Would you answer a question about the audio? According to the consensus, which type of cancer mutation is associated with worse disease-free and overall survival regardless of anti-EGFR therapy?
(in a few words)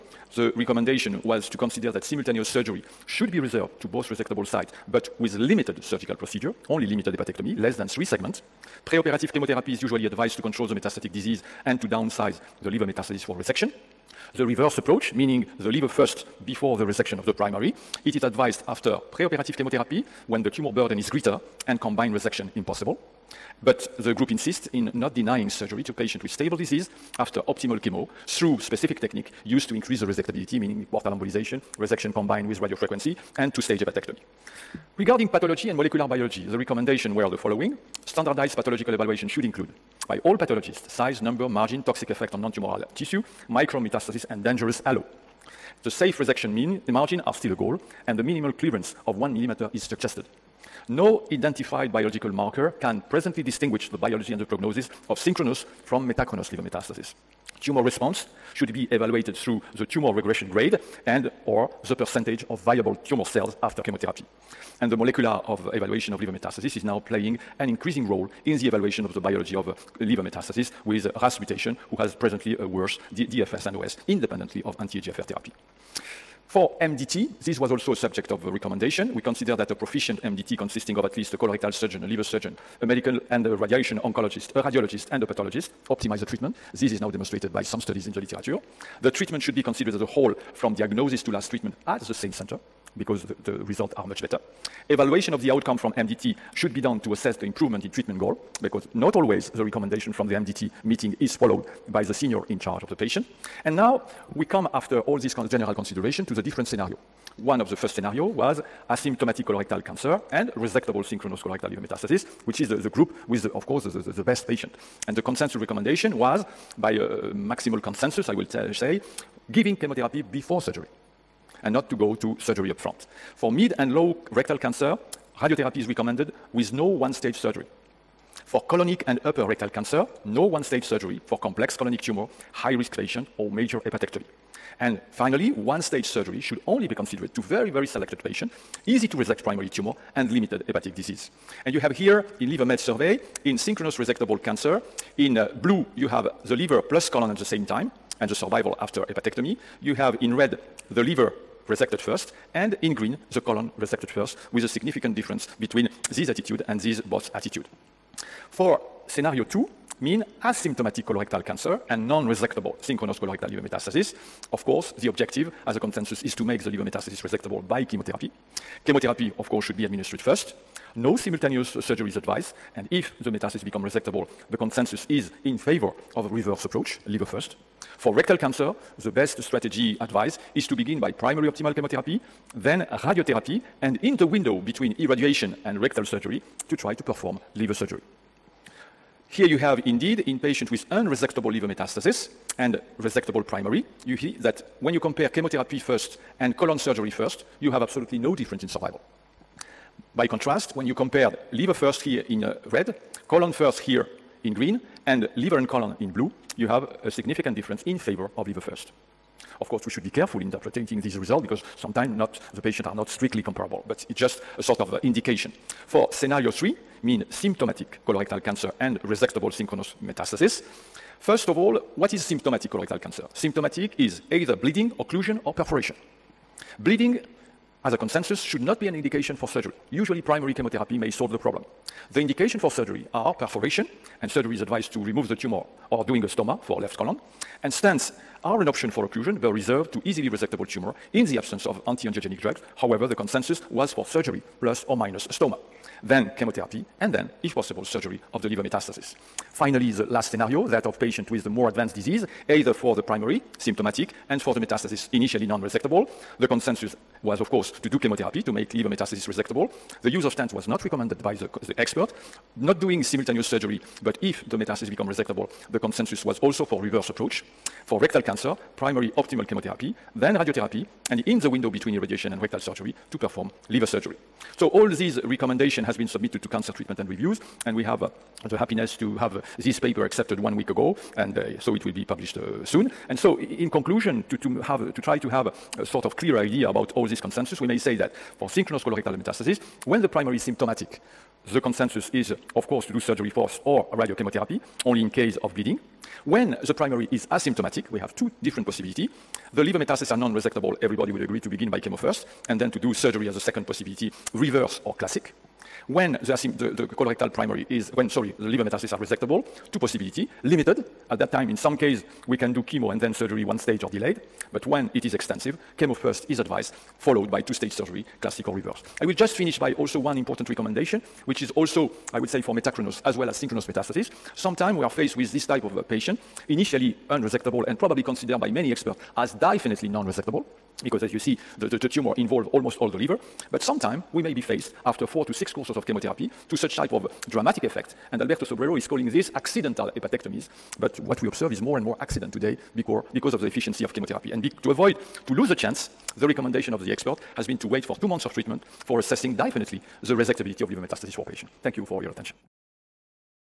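RAS mutation.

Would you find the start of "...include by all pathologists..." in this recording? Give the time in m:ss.
0:39.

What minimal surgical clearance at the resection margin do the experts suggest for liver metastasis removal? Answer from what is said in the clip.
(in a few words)
1 millimeter.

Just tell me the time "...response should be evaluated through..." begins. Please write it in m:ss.
0:57.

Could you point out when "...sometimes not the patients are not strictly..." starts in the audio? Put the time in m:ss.
3:31.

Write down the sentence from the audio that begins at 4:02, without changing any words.
However, the consensus was for surgery plus or minus stoma, then chemotherapy, and then, if possible, surgery of the liver metastasis.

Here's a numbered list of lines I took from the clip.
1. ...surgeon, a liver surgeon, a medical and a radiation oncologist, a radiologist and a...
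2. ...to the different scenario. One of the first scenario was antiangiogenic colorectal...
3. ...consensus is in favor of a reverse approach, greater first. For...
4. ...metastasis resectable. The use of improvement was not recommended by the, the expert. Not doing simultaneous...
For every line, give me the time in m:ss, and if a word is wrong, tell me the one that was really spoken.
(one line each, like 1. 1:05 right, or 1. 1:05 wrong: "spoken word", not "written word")
1. 1:21 right
2. 1:46 wrong: "asymptomatic", not "antiangiogenic"
3. 2:54 wrong: "liver", not "greater"
4. 4:18 wrong: "stent", not "improvement".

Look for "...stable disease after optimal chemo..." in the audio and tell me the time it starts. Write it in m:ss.
0:26.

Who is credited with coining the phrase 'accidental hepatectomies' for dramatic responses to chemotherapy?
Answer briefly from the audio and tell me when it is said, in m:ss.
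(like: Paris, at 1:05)
Alberto Sobrero, at 5:38.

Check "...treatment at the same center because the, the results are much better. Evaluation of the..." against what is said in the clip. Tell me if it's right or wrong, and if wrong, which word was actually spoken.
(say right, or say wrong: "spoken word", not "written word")
right.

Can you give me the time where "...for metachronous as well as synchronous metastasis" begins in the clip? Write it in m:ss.
5:22.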